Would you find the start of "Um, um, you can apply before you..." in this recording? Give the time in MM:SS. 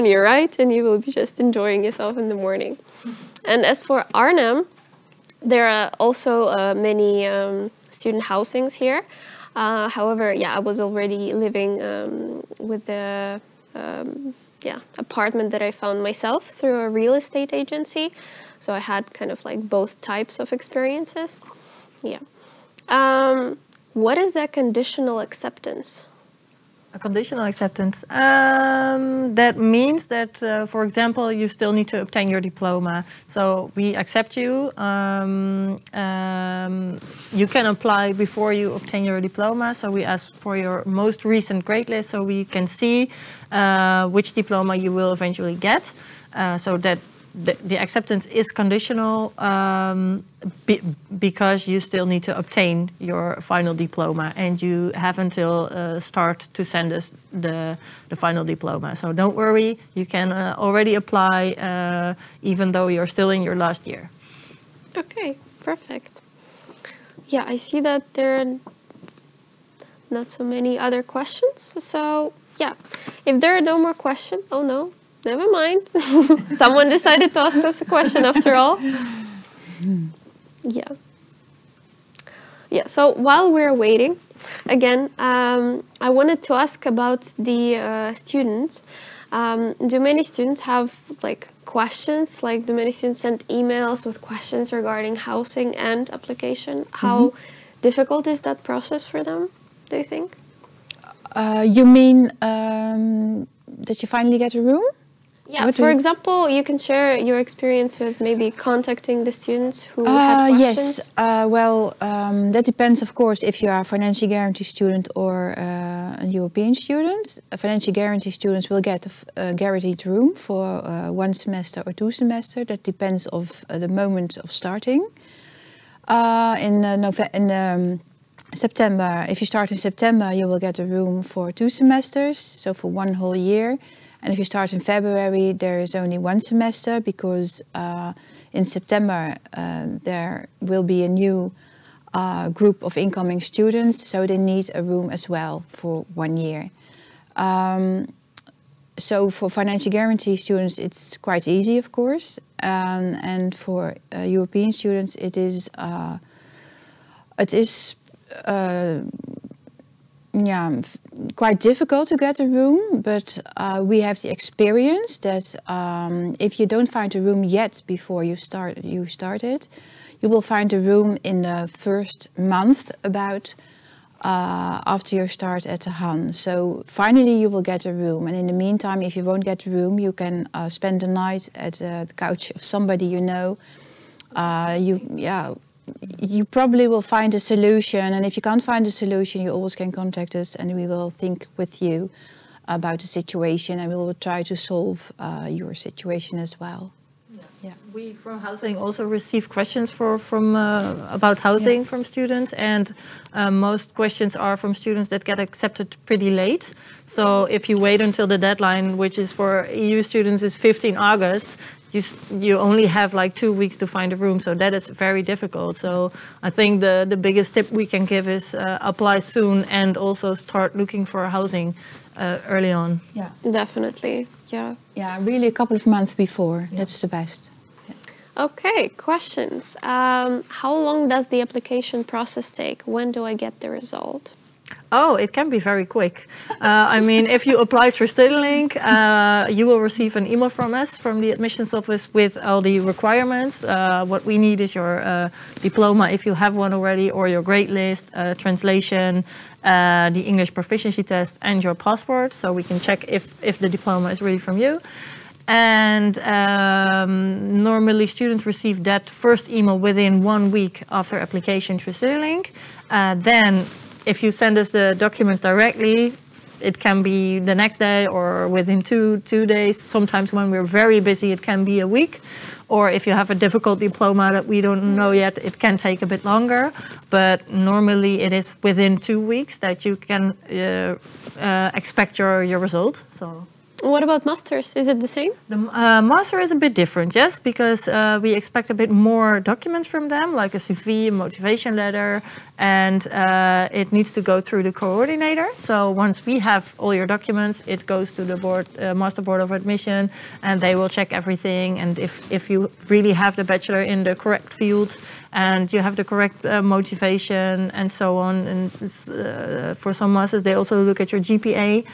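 00:34.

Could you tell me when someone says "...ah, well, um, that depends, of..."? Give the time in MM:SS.
01:51.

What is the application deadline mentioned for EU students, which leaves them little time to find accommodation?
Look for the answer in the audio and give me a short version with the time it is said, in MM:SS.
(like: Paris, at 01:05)
15 August, at 03:30.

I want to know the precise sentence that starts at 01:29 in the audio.
Um, do many students have like questions?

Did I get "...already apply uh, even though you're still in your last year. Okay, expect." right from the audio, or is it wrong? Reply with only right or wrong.
wrong.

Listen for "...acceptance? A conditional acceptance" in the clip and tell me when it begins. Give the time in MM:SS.
00:25.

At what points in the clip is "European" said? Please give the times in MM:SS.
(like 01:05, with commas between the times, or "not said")
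01:56, 02:34.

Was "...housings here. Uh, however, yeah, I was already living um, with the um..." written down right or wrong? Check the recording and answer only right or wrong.
right.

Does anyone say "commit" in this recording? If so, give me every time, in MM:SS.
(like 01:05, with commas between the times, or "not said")
not said.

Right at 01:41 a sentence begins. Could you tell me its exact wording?
Uh, you mean um, that you finally get a room?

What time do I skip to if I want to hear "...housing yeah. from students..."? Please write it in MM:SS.
03:21.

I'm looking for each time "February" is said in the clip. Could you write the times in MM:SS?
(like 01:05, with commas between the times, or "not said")
02:14.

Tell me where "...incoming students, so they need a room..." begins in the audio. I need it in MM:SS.
02:22.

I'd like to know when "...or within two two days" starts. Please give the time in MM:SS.
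04:28.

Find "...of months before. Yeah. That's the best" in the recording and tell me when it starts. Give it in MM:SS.
03:45.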